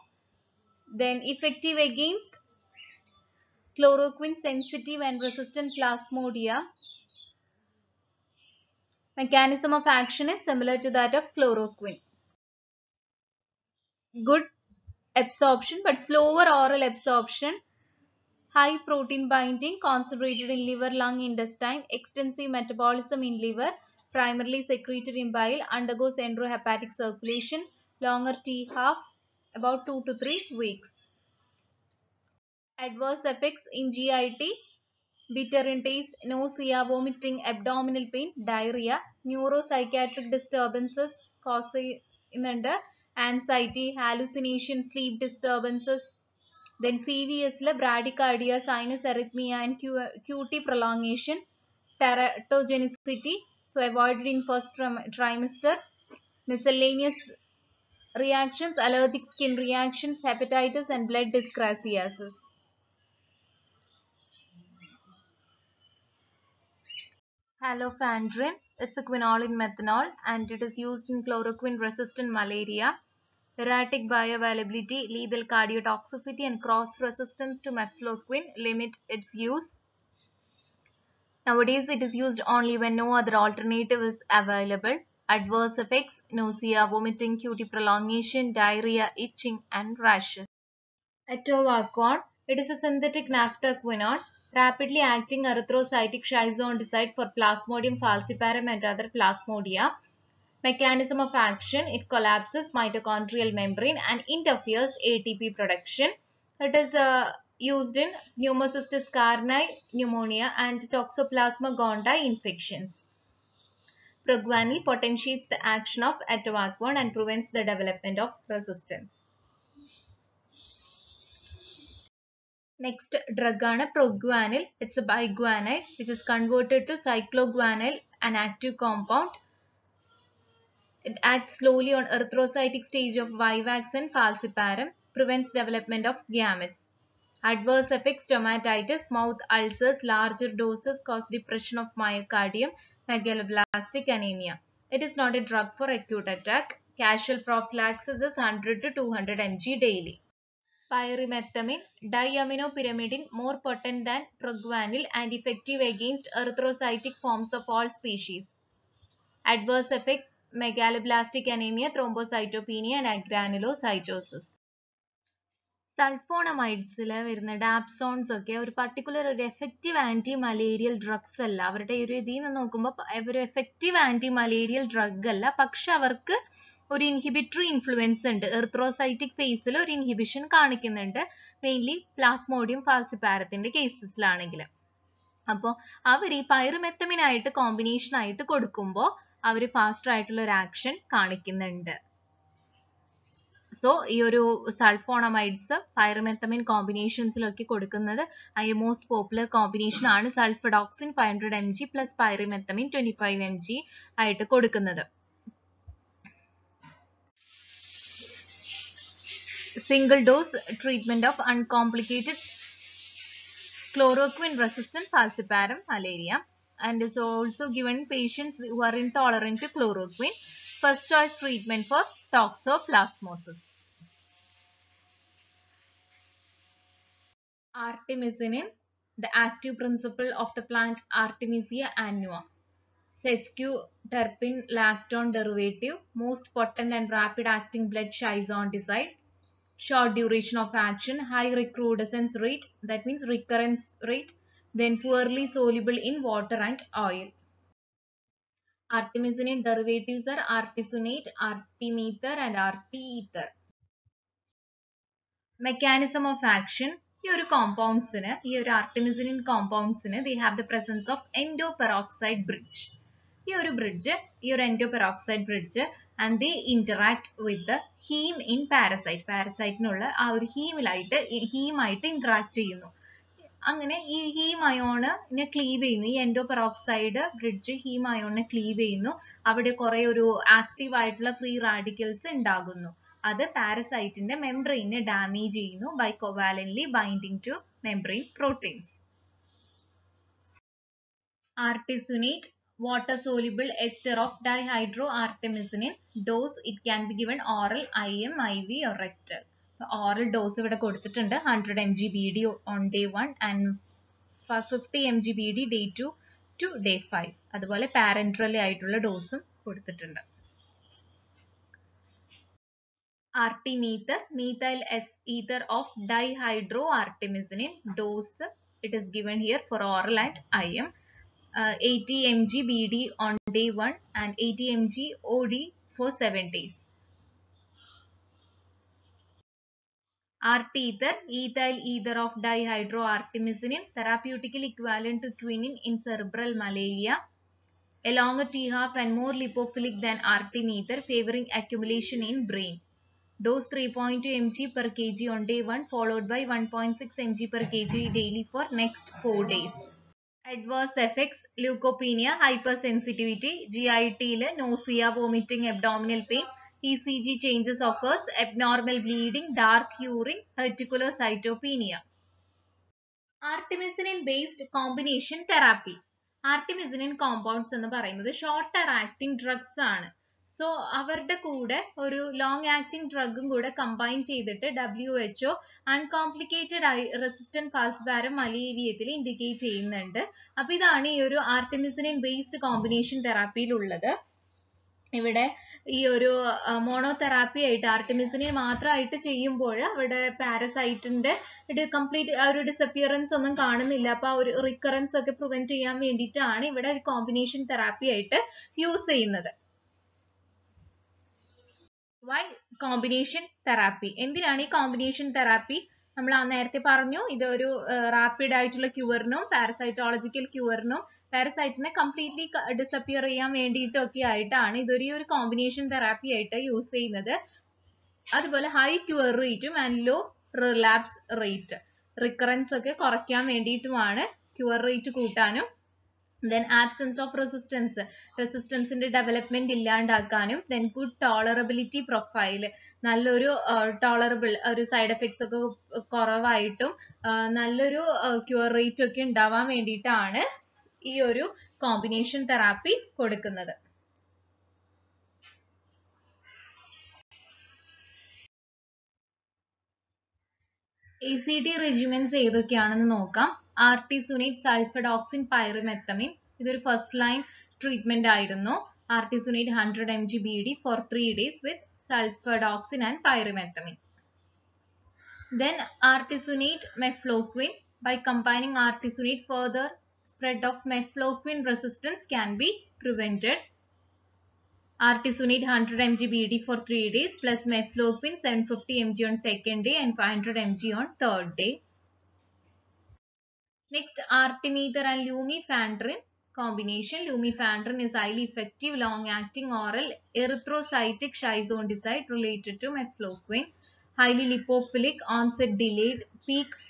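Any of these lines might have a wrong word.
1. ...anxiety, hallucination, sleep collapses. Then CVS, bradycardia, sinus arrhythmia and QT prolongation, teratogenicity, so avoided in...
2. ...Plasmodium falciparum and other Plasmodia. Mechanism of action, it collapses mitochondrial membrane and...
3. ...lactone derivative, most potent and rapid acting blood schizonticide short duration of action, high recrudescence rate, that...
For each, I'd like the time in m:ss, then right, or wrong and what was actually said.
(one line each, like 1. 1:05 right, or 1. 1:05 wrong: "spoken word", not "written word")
1. 0:43 wrong: "disturbances", not "collapses"
2. 1:37 right
3. 3:54 right.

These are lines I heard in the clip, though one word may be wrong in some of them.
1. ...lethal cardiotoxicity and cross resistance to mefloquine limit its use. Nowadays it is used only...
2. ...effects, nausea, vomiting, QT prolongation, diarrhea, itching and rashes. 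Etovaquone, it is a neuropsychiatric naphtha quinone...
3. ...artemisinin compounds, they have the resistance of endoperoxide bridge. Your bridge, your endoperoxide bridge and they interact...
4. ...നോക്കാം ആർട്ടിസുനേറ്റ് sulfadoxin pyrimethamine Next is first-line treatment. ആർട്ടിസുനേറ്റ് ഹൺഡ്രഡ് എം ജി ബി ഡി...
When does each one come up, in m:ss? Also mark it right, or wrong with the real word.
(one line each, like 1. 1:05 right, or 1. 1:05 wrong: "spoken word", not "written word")
1. 1:15 right
2. 1:25 wrong: "synthetic", not "neuropsychiatric"
3. 4:18 wrong: "presence", not "resistance"
4. 7:33 wrong: "This", not "Next".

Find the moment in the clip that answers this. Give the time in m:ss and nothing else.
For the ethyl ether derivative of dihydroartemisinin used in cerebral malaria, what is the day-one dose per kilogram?
5:43.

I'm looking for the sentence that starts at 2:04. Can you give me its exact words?
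It's a biguanide which is converted to cycloguanil, an active compound.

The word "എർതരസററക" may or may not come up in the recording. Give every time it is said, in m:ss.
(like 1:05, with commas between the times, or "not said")
2:58.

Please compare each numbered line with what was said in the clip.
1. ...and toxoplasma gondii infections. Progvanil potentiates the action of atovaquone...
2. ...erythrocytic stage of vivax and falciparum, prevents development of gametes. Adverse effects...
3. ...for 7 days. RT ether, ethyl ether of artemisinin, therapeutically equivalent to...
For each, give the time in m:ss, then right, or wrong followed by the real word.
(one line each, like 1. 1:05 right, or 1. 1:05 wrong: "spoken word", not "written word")
1. 1:50 right
2. 2:12 right
3. 5:25 wrong: "dihydroartemisinin", not "artemisinin".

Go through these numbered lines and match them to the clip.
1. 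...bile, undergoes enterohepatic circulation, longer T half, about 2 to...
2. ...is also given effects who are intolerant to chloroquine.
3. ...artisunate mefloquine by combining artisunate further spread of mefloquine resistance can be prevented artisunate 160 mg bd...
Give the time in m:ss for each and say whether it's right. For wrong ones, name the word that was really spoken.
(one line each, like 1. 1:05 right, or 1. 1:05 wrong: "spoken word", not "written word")
1. 0:25 right
2. 3:37 wrong: "patients", not "effects"
3. 7:46 wrong: "100", not "160".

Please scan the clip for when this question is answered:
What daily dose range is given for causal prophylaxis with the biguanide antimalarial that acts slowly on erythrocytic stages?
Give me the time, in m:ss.
2:28.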